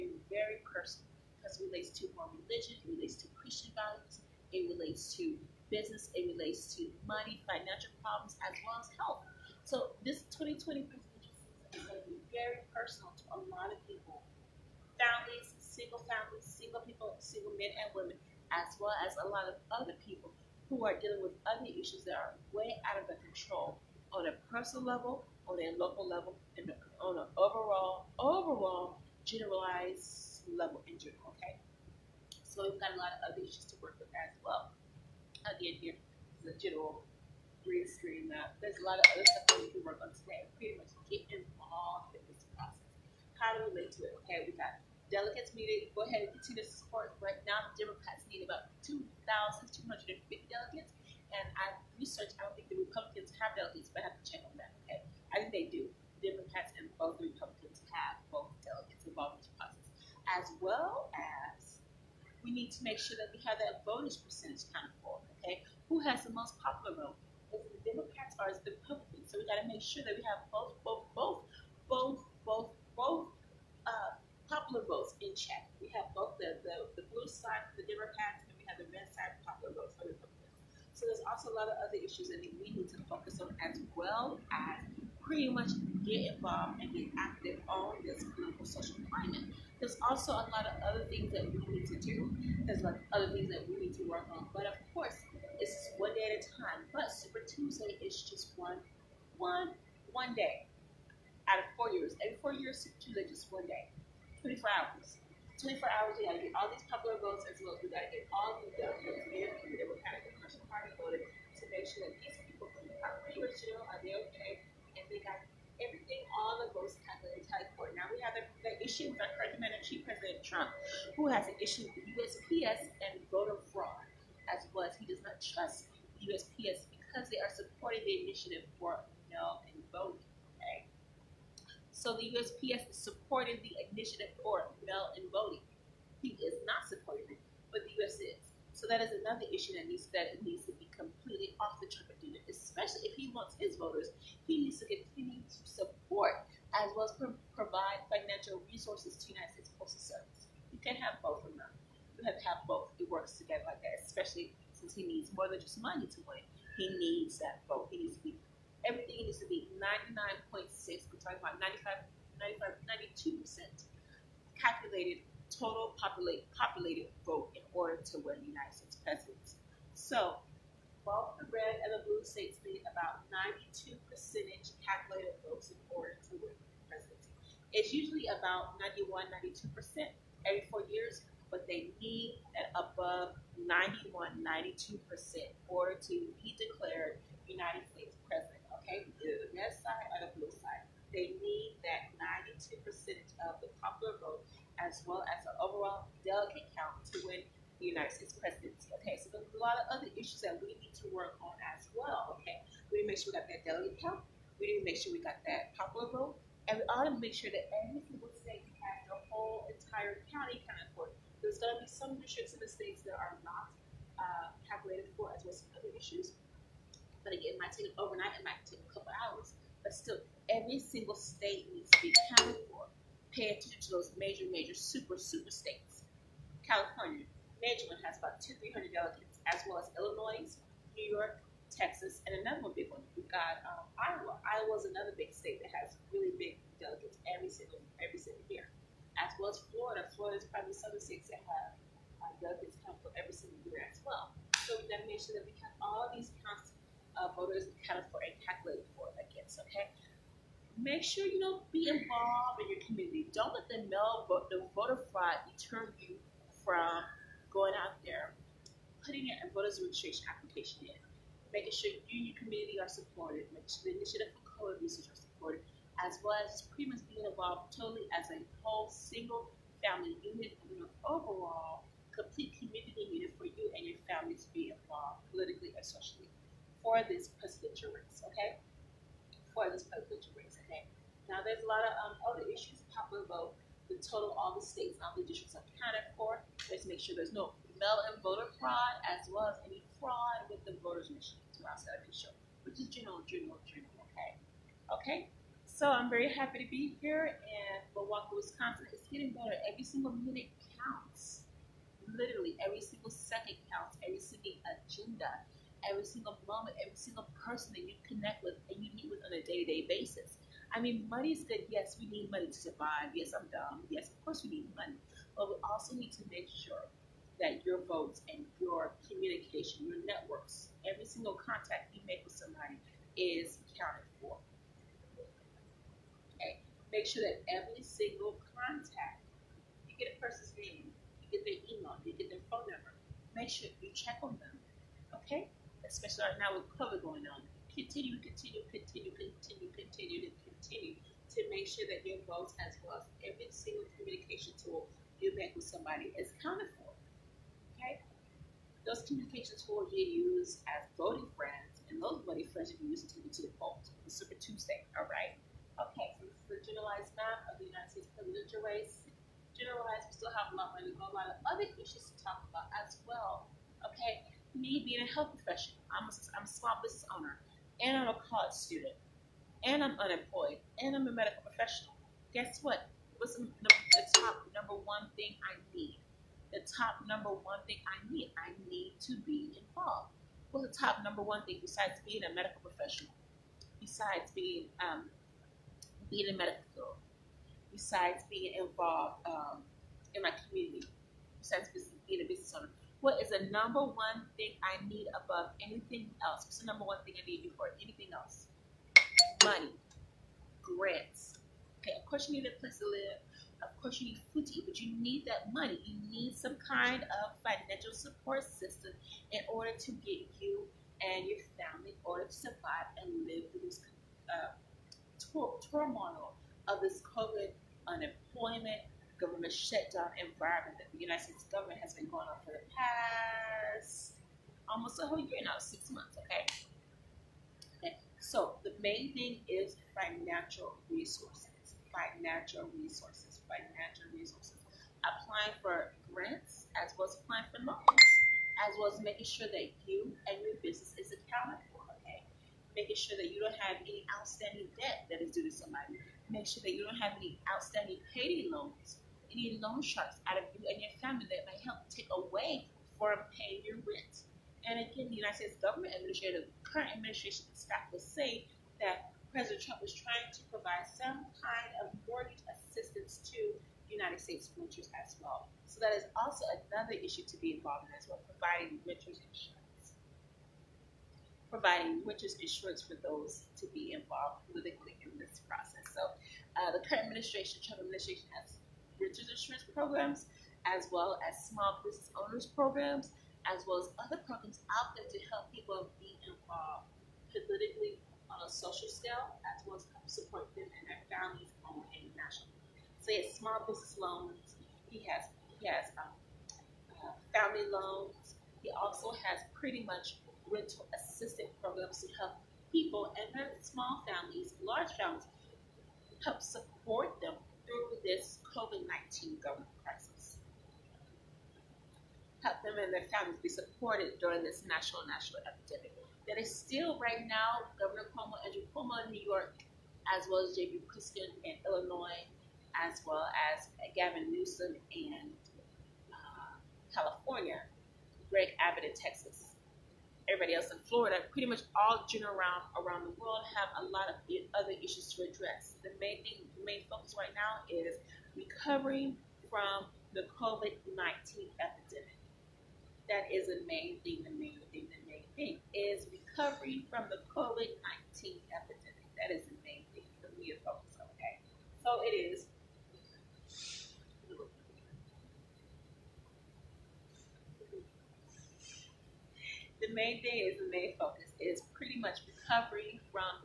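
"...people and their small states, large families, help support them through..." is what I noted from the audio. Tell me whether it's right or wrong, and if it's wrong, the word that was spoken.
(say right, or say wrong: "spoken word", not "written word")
wrong: "families", not "states".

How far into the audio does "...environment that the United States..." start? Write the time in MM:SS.
07:00.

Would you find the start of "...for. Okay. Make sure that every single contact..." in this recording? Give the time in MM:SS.
05:24.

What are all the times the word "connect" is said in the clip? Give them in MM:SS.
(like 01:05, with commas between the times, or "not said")
05:08.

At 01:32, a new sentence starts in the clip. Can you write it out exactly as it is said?
There's like other things that we need to work on.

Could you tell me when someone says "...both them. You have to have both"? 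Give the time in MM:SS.
02:31.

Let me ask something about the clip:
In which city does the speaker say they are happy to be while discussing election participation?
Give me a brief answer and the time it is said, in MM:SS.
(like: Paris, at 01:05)
Milwaukee, at 04:57.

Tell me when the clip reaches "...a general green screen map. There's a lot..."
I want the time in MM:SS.
00:36.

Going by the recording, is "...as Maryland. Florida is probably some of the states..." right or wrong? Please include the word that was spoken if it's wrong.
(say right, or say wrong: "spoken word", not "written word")
wrong: "Florida", not "Maryland".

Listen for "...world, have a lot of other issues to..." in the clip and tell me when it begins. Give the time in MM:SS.
08:53.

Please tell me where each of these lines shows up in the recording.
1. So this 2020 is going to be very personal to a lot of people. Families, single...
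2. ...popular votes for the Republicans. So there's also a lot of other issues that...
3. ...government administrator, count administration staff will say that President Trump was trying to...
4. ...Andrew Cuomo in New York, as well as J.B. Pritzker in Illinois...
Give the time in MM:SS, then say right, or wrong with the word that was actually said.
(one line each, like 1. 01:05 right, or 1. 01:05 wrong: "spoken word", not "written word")
1. 00:09 right
2. 01:19 right
3. 07:35 wrong: "current", not "count"
4. 08:38 right.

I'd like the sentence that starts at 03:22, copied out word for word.
Okay, we need to make sure we got that delegate count.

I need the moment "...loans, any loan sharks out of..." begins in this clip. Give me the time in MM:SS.
07:28.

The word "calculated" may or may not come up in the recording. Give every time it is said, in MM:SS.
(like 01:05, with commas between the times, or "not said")
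02:44, 02:54, 03:34, 04:08.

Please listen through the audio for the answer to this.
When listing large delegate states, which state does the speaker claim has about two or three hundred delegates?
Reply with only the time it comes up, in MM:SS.
03:47.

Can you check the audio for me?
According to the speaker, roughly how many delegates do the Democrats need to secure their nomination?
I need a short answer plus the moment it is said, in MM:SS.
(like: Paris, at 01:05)
2,250, at 00:48.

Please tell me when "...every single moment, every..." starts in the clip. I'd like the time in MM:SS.
05:05.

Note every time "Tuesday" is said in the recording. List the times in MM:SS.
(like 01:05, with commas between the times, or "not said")
01:37, 01:42, 05:54.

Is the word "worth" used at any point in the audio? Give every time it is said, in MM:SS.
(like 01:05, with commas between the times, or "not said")
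not said.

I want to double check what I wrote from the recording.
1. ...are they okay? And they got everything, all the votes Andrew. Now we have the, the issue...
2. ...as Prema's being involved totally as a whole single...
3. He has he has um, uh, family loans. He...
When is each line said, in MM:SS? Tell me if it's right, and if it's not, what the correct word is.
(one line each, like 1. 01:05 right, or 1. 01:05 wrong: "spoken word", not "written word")
1. 01:53 wrong: "Court", not "Andrew"
2. 04:26 right
3. 08:14 right.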